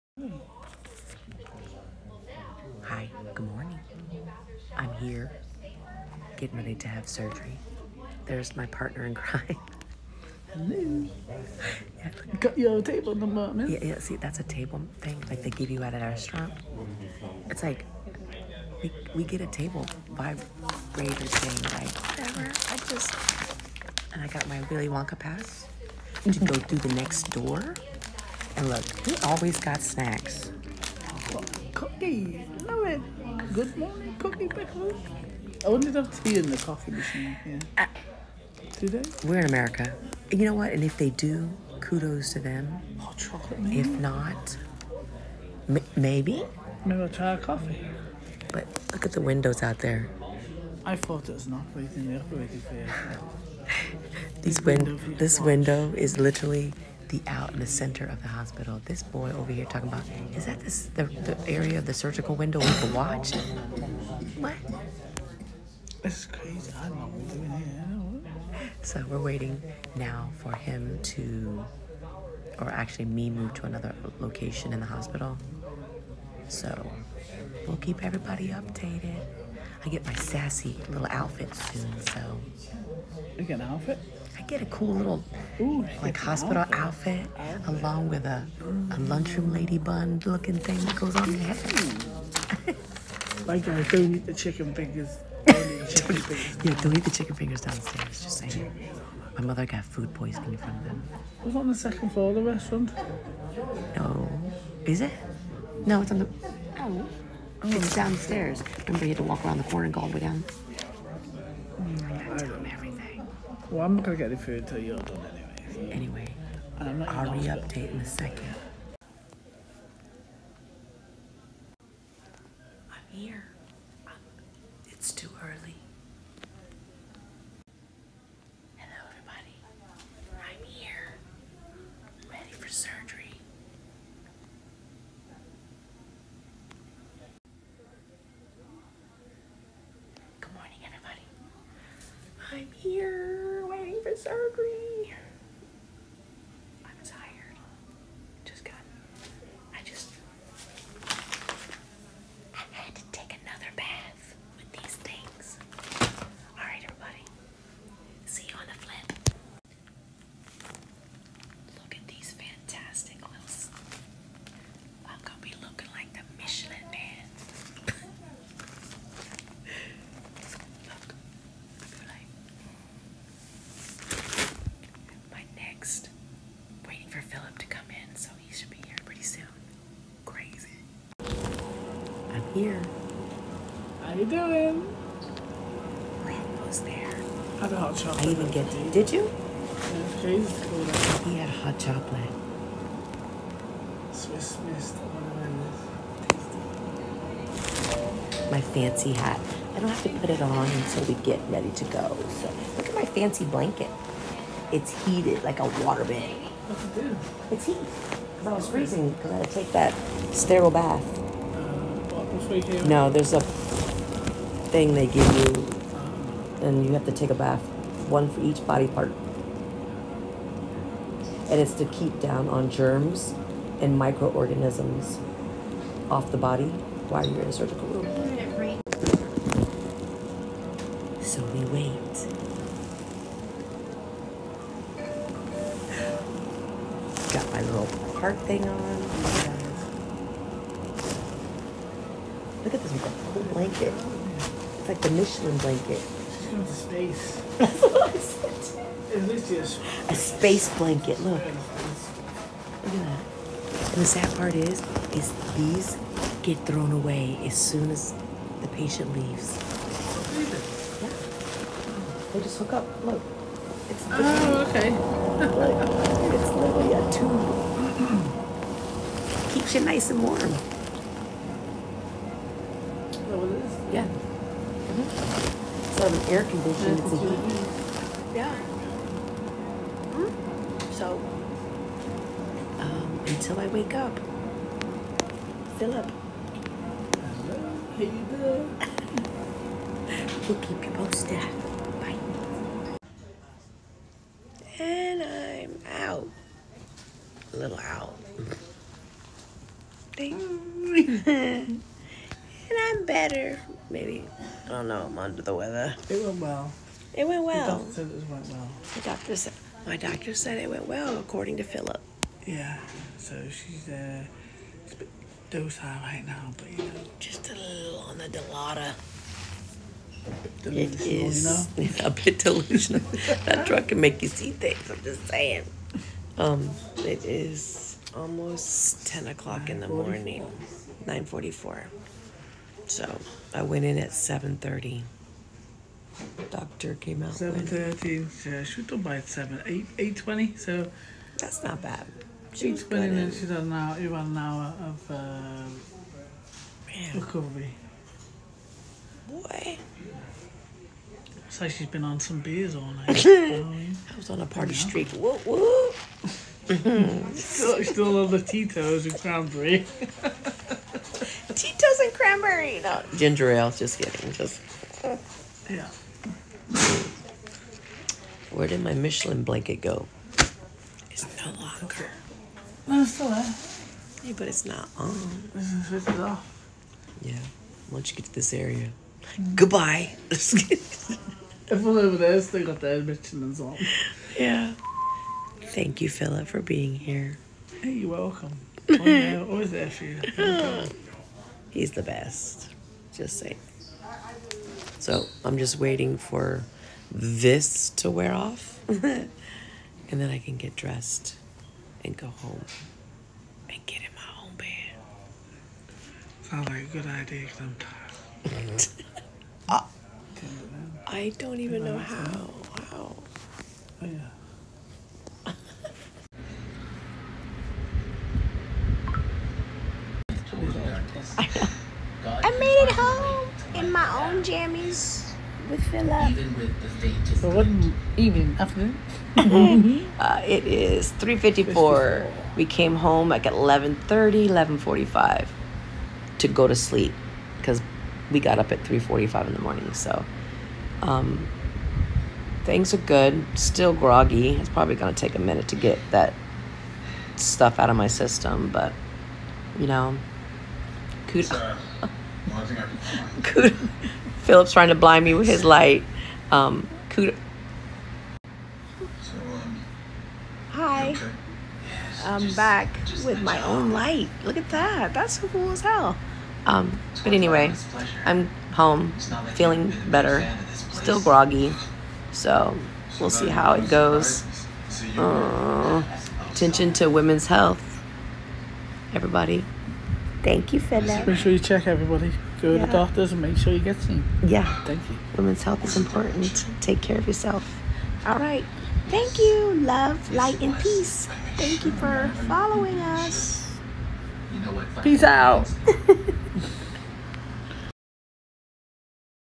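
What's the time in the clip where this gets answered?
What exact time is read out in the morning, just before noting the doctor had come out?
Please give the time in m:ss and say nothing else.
5:31.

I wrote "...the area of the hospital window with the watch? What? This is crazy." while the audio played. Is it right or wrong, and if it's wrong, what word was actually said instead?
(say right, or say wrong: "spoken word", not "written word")
wrong: "surgical", not "hospital".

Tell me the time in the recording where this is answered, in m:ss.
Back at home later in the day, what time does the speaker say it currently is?
7:11.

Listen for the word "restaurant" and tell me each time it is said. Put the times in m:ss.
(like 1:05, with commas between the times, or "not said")
0:15, 1:42.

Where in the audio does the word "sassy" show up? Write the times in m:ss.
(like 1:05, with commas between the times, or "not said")
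1:20.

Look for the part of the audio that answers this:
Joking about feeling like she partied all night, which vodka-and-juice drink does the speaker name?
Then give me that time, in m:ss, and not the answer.
5:58.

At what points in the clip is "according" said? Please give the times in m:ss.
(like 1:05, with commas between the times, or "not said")
5:11.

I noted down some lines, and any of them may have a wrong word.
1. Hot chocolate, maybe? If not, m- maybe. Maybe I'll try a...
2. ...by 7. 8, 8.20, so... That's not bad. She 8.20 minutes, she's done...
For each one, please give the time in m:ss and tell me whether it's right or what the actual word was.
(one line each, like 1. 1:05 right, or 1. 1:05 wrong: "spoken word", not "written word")
1. 0:42 right
2. 5:39 right.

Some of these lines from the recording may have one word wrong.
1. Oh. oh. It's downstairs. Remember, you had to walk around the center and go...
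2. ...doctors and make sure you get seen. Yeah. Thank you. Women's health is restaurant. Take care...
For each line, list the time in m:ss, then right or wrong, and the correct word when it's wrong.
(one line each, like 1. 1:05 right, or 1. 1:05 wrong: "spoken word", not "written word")
1. 1:46 wrong: "corner", not "center"
2. 8:02 wrong: "important", not "restaurant".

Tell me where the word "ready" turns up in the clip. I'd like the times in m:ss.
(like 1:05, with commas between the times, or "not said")
0:06, 2:12, 3:21.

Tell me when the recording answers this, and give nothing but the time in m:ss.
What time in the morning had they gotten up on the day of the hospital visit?
7:18.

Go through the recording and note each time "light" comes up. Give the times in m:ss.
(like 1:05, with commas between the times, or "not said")
7:35, 7:43, 8:10.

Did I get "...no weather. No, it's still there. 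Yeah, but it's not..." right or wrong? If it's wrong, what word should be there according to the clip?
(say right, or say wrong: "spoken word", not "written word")
wrong: "longer", not "weather".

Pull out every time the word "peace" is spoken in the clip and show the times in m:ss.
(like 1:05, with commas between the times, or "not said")
8:10, 8:15.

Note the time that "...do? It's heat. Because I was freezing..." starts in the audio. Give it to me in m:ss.
3:26.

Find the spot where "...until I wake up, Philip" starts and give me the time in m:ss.
4:43.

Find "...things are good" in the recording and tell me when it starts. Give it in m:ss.
7:22.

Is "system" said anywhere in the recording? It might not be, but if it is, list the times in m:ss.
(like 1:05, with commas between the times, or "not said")
7:28.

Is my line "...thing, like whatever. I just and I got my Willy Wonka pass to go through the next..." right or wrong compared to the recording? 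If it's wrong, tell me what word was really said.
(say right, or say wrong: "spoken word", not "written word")
right.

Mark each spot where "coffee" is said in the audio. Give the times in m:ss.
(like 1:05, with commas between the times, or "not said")
0:36, 0:47.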